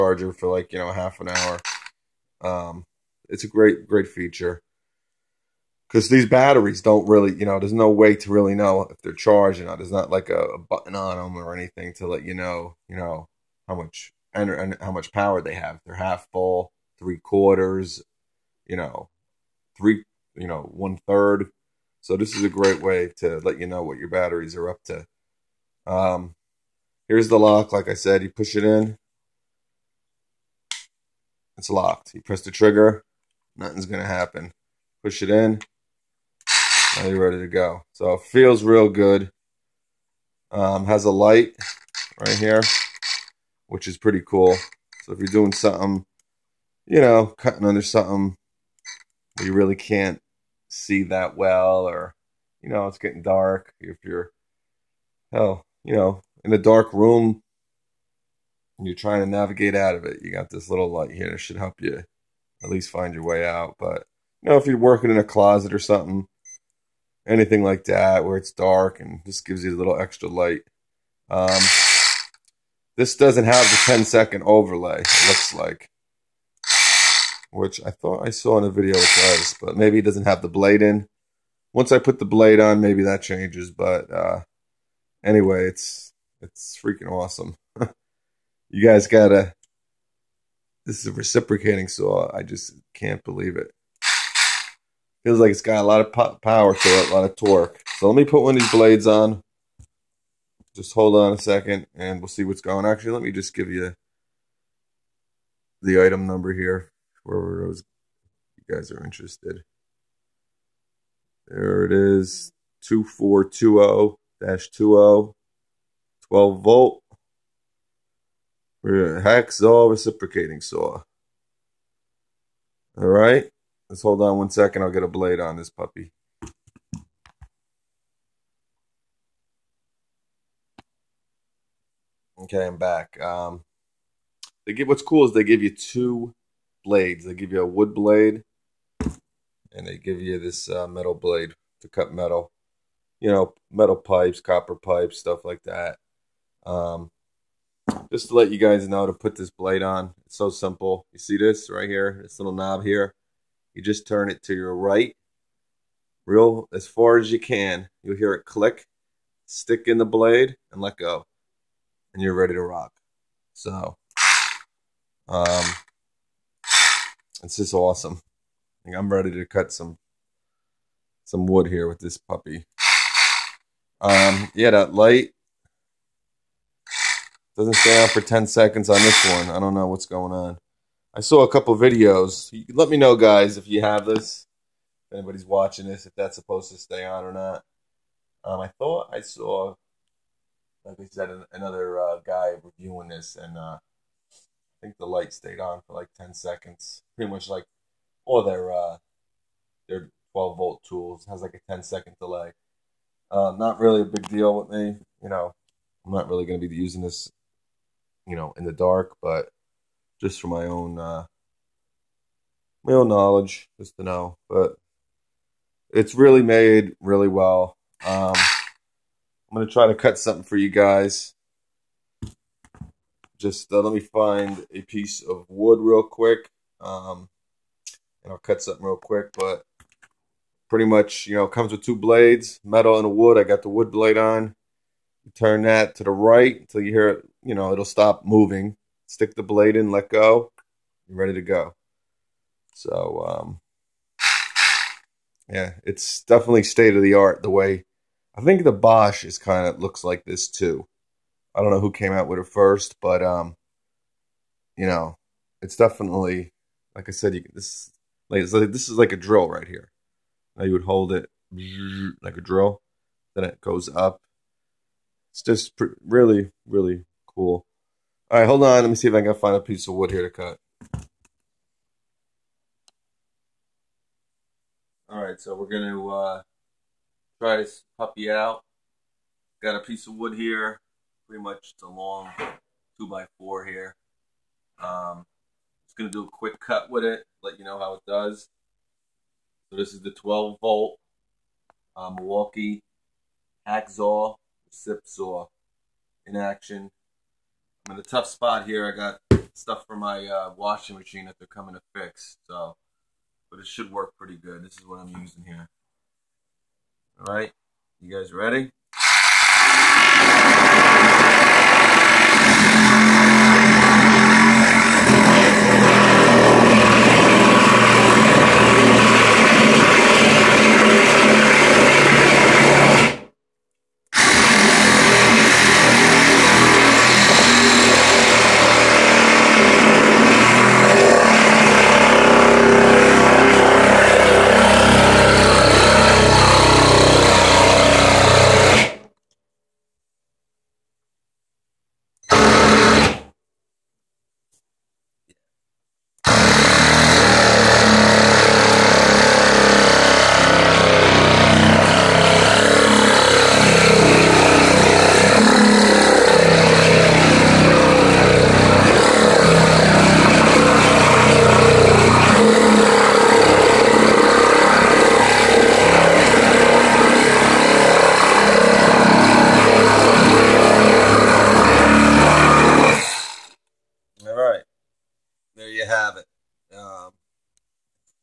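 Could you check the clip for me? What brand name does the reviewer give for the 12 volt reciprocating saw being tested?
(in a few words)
Milwaukee.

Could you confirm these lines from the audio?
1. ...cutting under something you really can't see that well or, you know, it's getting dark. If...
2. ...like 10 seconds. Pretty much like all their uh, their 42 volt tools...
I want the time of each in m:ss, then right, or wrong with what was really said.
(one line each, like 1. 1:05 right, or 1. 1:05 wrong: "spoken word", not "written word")
1. 0:47 right
2. 3:15 wrong: "12", not "42".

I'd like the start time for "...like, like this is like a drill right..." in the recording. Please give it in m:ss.
4:18.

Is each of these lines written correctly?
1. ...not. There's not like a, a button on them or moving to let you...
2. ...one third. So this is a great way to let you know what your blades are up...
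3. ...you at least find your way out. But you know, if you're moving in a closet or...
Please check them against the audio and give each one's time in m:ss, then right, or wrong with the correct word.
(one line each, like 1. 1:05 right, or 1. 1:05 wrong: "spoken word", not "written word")
1. 0:09 wrong: "anything", not "moving"
2. 0:20 wrong: "batteries", not "blades"
3. 1:01 wrong: "working", not "moving".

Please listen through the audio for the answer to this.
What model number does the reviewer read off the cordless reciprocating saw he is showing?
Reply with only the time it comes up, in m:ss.
1:52.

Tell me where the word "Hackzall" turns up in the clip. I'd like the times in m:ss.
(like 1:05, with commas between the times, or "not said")
1:58, 4:53.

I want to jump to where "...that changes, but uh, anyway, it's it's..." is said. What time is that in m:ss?
1:23.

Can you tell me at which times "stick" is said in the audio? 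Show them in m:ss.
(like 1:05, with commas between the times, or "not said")
2:39, 3:59.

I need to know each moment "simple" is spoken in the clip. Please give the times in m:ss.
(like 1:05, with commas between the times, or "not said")
2:30.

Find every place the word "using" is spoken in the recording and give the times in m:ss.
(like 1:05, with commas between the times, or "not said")
3:26, 5:05.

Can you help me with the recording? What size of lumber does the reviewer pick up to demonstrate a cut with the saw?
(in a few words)
2 by 4.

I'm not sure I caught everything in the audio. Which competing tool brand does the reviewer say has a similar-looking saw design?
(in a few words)
Bosch.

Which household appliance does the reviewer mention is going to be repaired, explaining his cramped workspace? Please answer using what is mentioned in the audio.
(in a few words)
Washing machine.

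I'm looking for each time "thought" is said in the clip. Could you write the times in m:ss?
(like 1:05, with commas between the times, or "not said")
1:17, 3:08.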